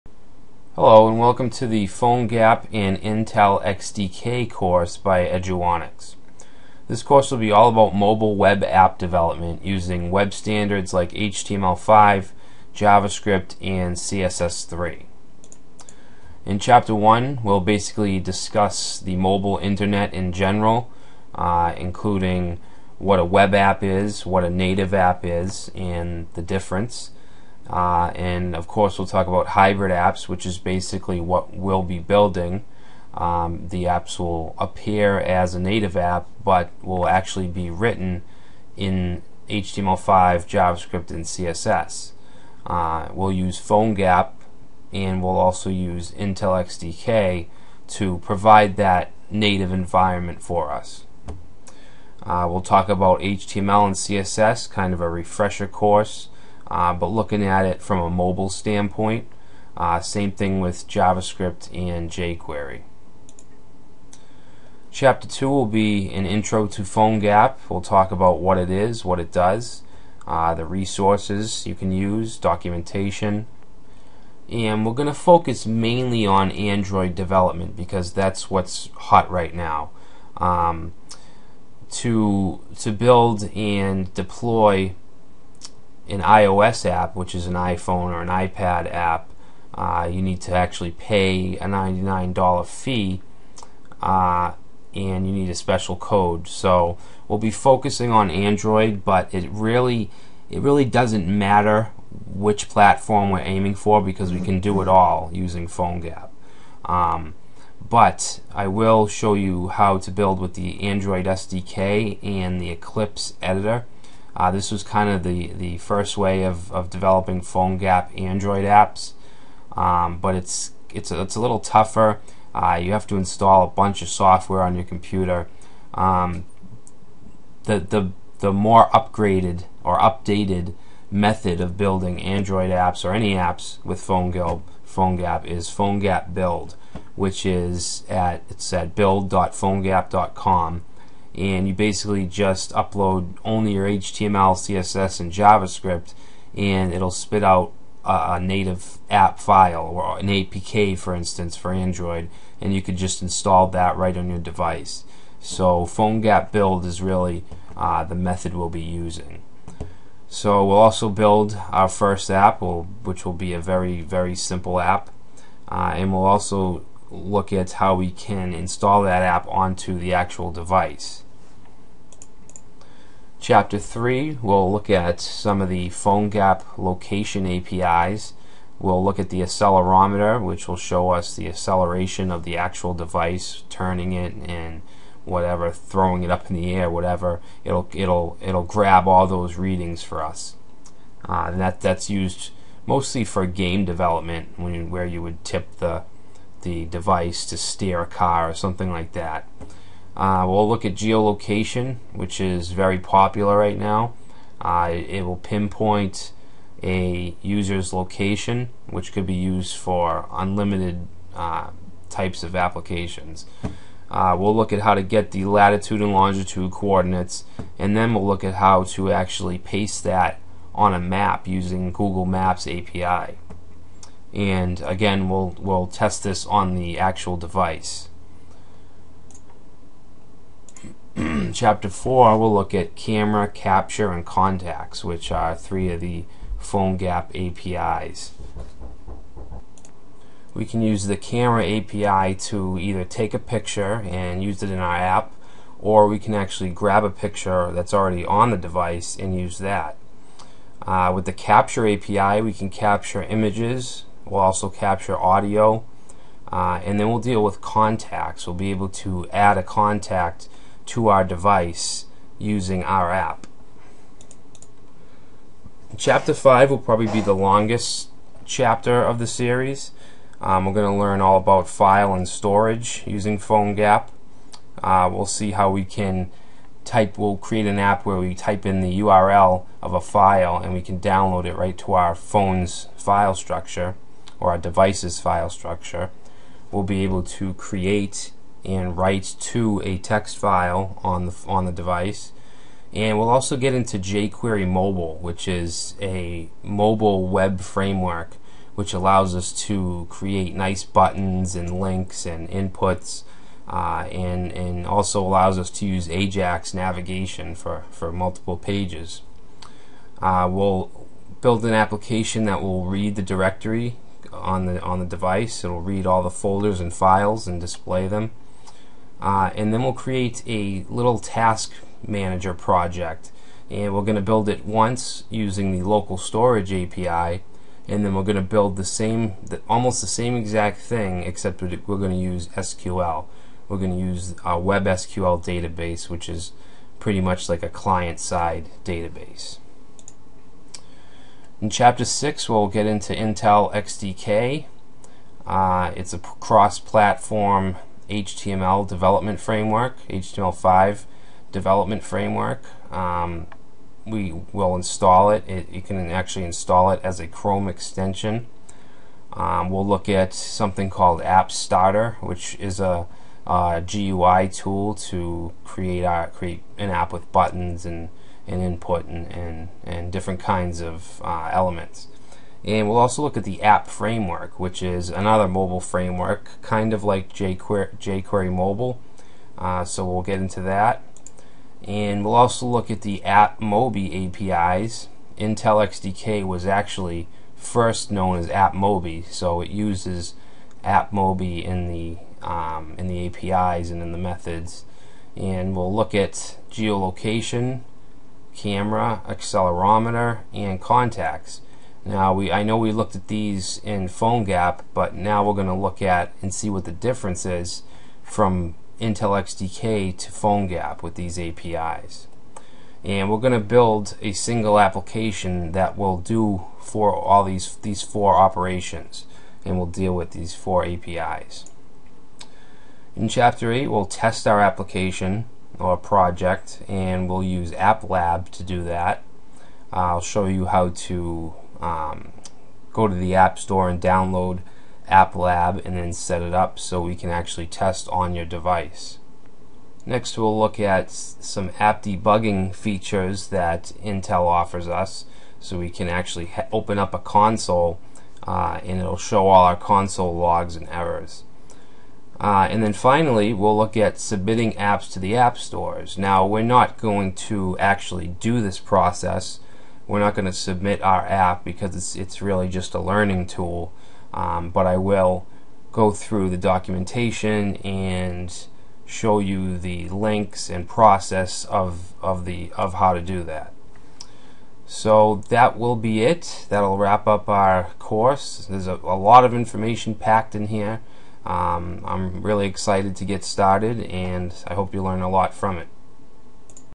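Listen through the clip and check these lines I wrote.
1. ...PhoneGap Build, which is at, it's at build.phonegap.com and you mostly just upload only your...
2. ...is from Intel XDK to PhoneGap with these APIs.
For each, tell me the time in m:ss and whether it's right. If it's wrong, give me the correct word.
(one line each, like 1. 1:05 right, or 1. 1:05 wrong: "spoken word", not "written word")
1. 2:15 wrong: "basically", not "mostly"
2. 6:47 right.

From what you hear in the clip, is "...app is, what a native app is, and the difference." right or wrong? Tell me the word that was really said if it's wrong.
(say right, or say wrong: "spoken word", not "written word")
right.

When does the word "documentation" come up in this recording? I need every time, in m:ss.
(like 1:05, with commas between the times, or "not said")
1:12, 7:46.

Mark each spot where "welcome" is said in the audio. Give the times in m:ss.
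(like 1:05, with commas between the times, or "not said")
0:01.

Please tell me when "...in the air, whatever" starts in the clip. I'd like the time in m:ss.
3:06.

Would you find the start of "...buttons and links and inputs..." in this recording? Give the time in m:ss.
5:00.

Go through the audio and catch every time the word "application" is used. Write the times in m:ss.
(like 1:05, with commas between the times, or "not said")
3:32, 5:11, 6:54, 7:04.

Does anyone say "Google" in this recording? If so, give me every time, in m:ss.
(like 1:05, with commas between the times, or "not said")
3:41.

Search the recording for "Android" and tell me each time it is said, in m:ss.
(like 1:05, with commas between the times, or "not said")
1:16, 1:38, 1:50, 1:58, 2:12, 2:31.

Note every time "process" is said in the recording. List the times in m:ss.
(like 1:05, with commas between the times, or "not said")
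7:38, 7:50.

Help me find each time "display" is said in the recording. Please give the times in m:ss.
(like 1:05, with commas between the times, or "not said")
5:17.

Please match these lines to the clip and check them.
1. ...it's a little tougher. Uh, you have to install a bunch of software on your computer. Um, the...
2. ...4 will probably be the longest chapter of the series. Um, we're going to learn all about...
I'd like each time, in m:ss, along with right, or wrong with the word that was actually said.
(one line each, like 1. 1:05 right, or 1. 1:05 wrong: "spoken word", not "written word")
1. 2:01 right
2. 4:26 wrong: "5", not "4".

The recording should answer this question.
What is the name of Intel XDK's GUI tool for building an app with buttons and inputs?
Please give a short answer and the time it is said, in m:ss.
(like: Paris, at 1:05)
App Starter, at 6:01.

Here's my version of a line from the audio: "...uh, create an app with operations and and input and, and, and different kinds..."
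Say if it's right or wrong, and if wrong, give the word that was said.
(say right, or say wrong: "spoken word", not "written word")
wrong: "buttons", not "operations".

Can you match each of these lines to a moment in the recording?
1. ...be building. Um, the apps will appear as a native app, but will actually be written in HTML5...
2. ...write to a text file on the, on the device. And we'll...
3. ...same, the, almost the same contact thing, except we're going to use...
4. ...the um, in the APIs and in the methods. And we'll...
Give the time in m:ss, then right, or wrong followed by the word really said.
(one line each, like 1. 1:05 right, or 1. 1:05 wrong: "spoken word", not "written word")
1. 0:31 right
2. 4:48 right
3. 5:28 wrong: "exact", not "contact"
4. 6:31 right.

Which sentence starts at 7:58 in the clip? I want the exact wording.
There's a, a lot of information packed in here.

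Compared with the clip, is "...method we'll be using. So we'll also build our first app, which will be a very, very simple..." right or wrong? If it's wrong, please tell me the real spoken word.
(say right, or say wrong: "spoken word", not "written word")
right.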